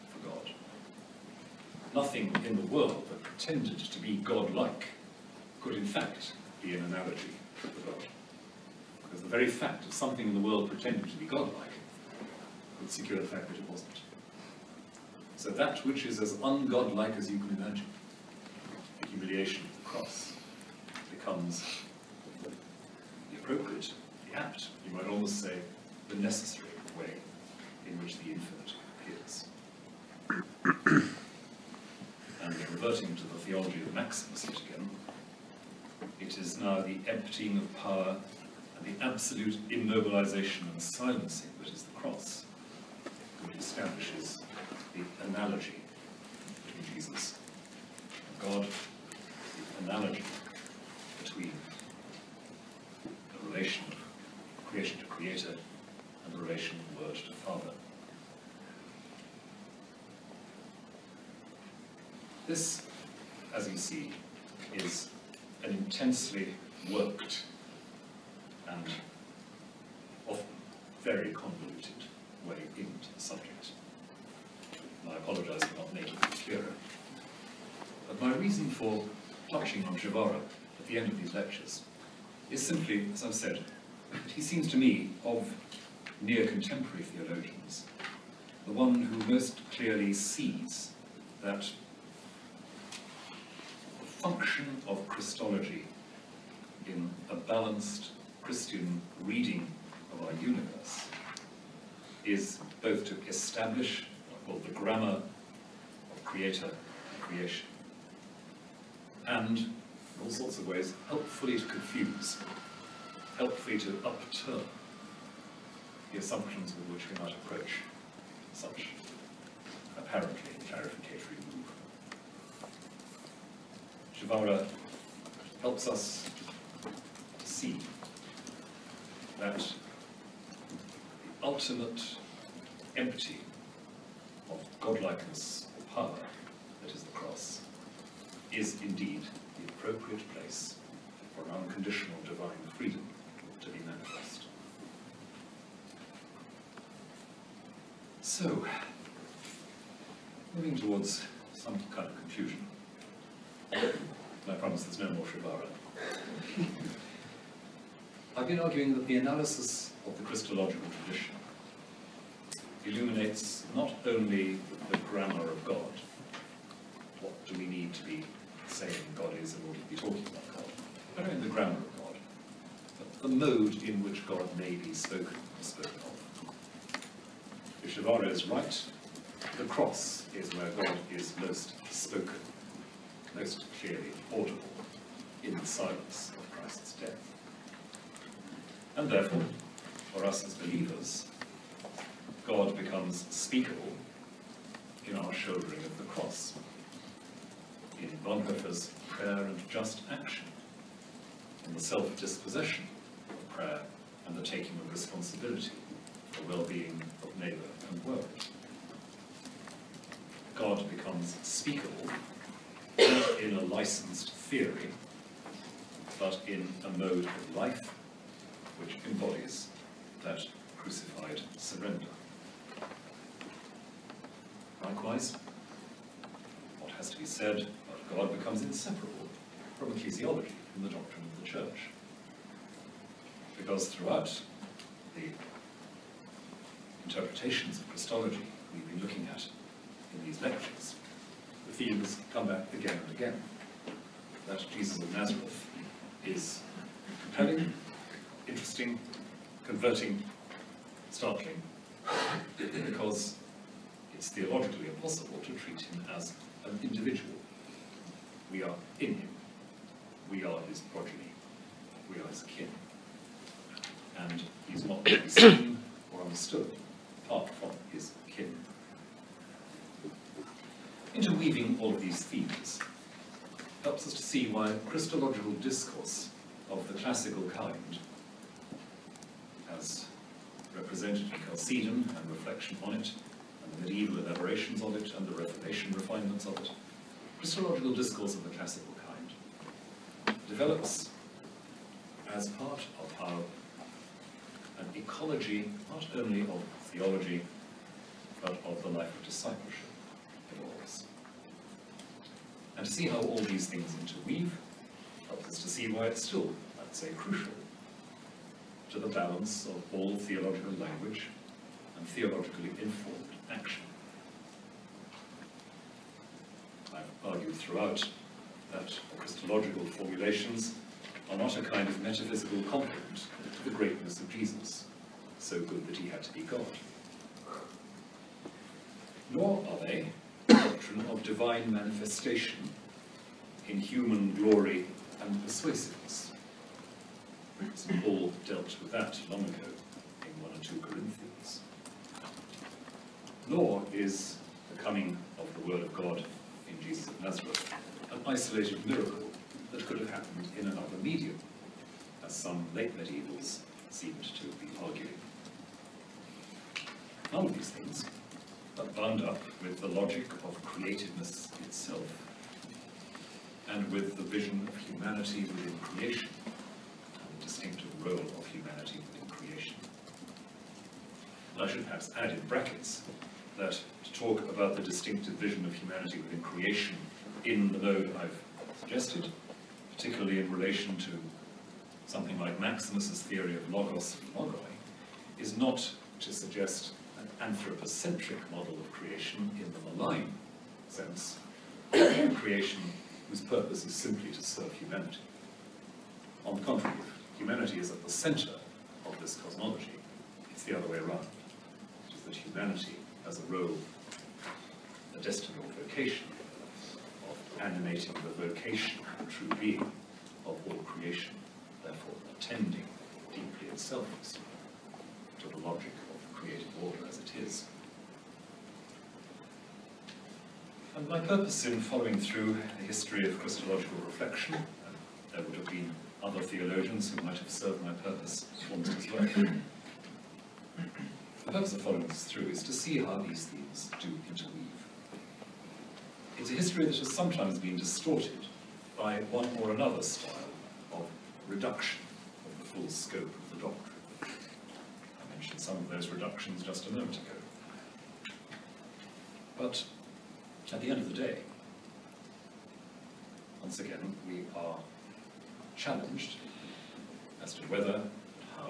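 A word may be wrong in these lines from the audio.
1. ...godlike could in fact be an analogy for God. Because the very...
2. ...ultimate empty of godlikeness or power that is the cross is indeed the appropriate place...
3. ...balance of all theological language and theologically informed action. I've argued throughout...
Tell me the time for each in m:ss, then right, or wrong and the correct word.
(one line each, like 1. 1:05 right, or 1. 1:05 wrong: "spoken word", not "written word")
1. 0:04 right
2. 2:11 right
3. 5:09 right.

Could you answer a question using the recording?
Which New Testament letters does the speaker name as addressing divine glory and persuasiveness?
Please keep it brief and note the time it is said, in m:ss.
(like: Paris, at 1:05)
1 or 2 Corinthians, at 5:40.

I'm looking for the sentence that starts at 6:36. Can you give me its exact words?
On the contrary, humanity is at the center of this cosmology, it's the other way around.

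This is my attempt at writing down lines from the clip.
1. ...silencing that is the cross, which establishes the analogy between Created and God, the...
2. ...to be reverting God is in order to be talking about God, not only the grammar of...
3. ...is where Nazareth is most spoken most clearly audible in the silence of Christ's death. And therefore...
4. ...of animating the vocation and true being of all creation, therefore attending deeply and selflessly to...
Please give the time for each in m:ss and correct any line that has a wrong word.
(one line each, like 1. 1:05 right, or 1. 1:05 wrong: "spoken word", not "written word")
1. 0:40 wrong: "Jesus", not "Created"
2. 2:47 wrong: "saying", not "reverting"
3. 3:00 wrong: "God", not "Nazareth"
4. 6:47 right.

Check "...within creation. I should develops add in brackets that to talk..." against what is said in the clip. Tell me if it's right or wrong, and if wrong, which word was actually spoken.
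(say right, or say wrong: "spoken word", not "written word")
wrong: "perhaps", not "develops".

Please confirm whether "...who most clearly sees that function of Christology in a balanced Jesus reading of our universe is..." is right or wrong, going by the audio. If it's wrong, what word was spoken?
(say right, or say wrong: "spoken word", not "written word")
wrong: "Christian", not "Jesus".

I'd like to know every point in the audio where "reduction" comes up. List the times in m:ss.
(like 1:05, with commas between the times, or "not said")
7:21, 7:26.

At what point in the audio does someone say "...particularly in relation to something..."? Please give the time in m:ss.
6:19.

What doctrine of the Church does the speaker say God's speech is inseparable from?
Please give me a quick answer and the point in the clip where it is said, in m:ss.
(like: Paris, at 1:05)
ecclesiology, at 3:49.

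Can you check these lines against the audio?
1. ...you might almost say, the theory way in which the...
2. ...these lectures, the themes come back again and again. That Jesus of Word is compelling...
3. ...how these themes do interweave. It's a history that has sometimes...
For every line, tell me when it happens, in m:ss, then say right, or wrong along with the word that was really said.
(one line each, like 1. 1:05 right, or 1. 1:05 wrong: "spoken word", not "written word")
1. 0:24 wrong: "necessary", not "theory"
2. 4:00 wrong: "Nazareth", not "Word"
3. 7:12 right.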